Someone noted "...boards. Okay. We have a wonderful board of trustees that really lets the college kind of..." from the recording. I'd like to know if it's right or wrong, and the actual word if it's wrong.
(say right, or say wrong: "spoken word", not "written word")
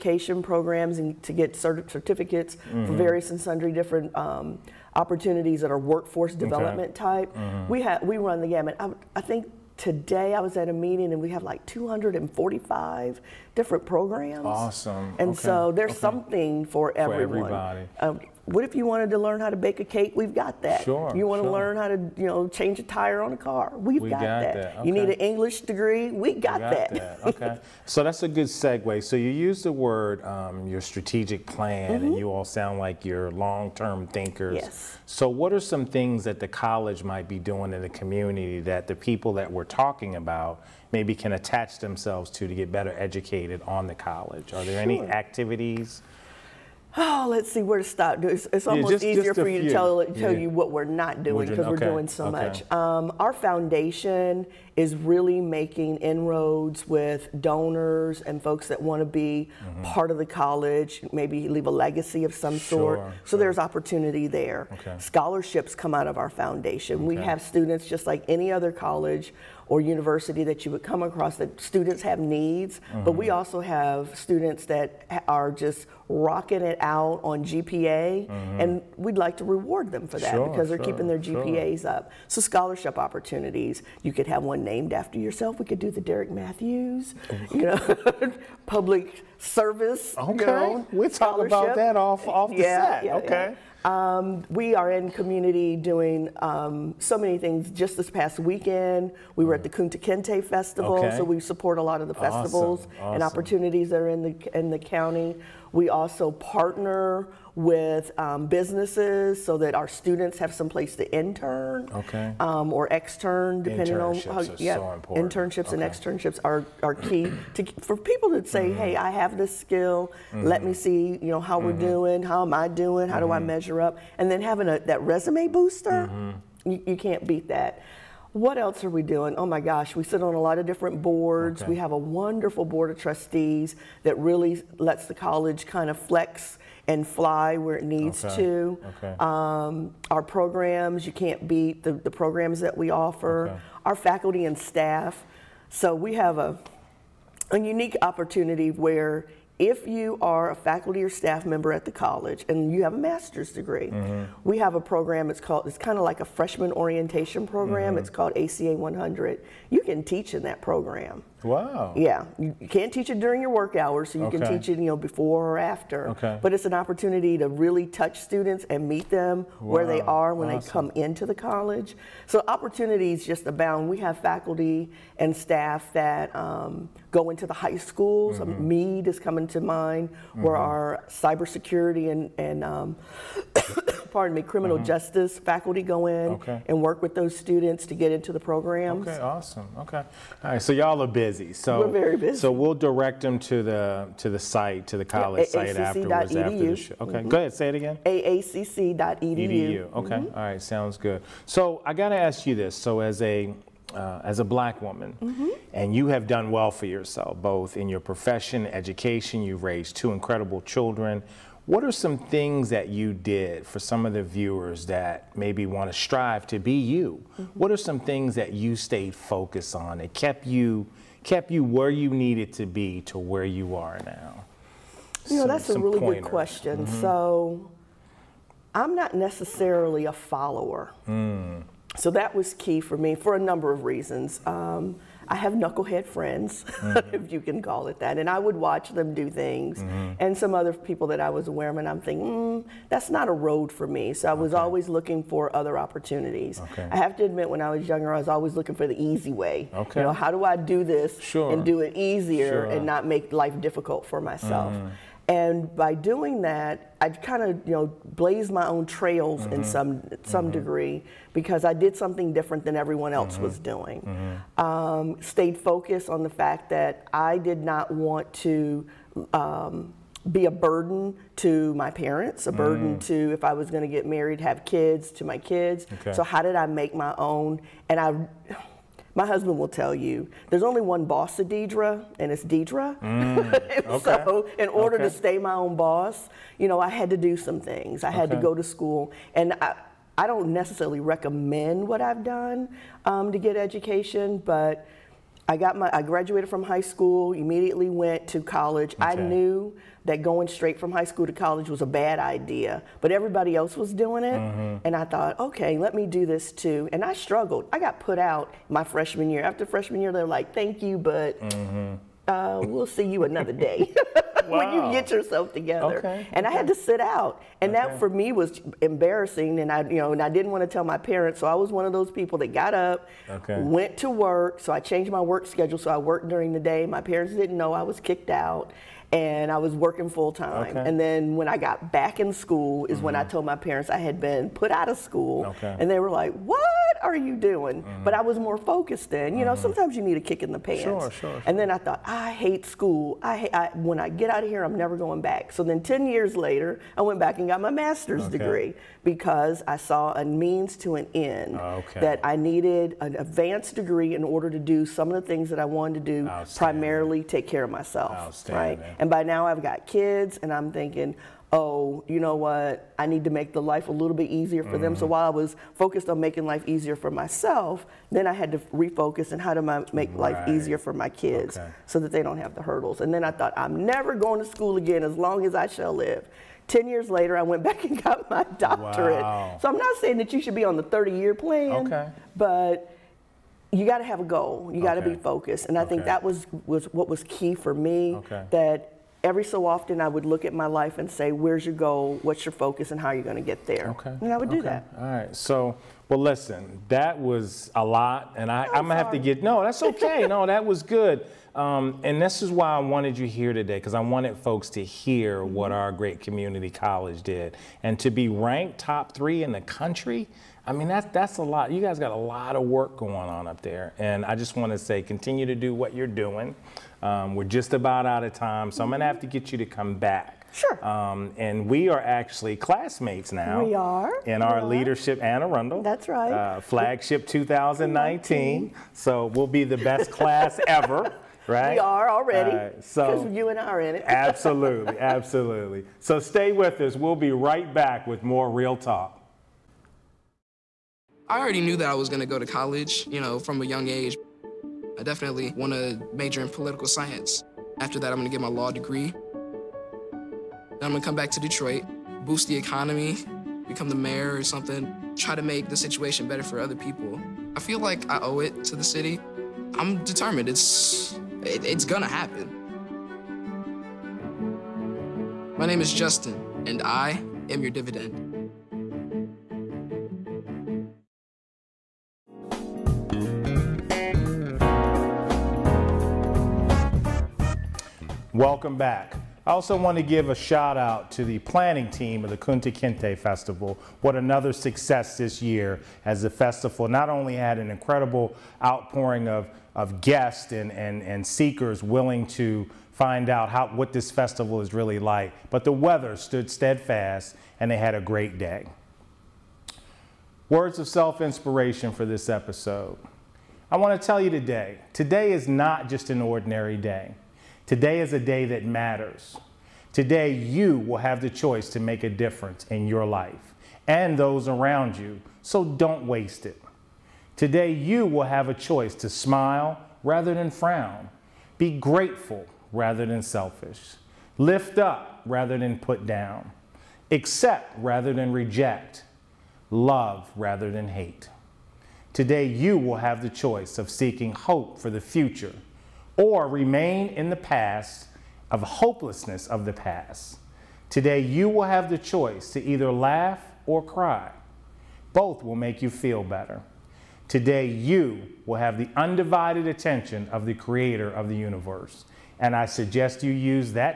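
right.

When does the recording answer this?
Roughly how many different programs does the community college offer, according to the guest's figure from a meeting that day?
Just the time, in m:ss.
0:11.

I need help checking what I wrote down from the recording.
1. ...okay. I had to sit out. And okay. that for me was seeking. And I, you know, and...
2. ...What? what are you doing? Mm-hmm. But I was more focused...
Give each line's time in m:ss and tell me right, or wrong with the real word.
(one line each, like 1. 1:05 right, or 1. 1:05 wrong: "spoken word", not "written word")
1. 5:16 wrong: "embarrassing", not "seeking"
2. 5:36 right.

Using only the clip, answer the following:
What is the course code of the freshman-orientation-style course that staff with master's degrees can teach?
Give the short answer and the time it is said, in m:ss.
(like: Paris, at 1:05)
ACA 100, at 2:38.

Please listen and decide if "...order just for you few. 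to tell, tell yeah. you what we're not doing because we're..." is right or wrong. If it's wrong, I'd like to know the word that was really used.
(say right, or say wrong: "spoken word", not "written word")
wrong: "easier", not "order".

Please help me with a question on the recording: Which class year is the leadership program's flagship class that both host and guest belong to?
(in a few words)
2019.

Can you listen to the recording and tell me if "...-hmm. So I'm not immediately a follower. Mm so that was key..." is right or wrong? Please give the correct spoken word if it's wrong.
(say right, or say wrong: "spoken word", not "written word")
wrong: "necessarily", not "immediately".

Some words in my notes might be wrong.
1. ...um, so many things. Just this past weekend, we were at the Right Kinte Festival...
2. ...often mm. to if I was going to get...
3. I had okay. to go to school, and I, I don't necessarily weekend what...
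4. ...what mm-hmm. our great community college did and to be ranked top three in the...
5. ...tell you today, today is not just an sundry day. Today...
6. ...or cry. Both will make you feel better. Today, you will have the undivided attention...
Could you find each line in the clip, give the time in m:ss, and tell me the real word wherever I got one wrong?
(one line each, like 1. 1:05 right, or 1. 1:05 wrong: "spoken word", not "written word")
1. 1:36 wrong: "Kunta", not "Right"
2. 4:32 wrong: "burden", not "often"
3. 4:48 wrong: "recommend", not "weekend"
4. 6:45 right
5. 8:24 wrong: "ordinary", not "sundry"
6. 9:03 right.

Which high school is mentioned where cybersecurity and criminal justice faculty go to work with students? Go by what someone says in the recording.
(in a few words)
Meade.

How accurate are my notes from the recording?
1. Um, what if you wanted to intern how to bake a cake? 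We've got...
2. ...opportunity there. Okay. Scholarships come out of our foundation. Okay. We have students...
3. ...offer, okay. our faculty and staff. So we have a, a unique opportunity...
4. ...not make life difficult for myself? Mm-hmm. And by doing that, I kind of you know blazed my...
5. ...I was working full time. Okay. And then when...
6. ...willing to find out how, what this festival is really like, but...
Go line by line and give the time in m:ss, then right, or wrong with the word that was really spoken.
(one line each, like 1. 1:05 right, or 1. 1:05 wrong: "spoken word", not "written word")
1. 0:17 wrong: "learn", not "intern"
2. 1:03 right
3. 2:22 right
4. 4:12 right
5. 5:29 right
6. 8:11 right.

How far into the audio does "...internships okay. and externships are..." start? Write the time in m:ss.
1:55.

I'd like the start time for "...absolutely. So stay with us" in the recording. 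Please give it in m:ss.
7:14.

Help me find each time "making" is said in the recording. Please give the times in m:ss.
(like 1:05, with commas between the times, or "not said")
0:55, 6:06.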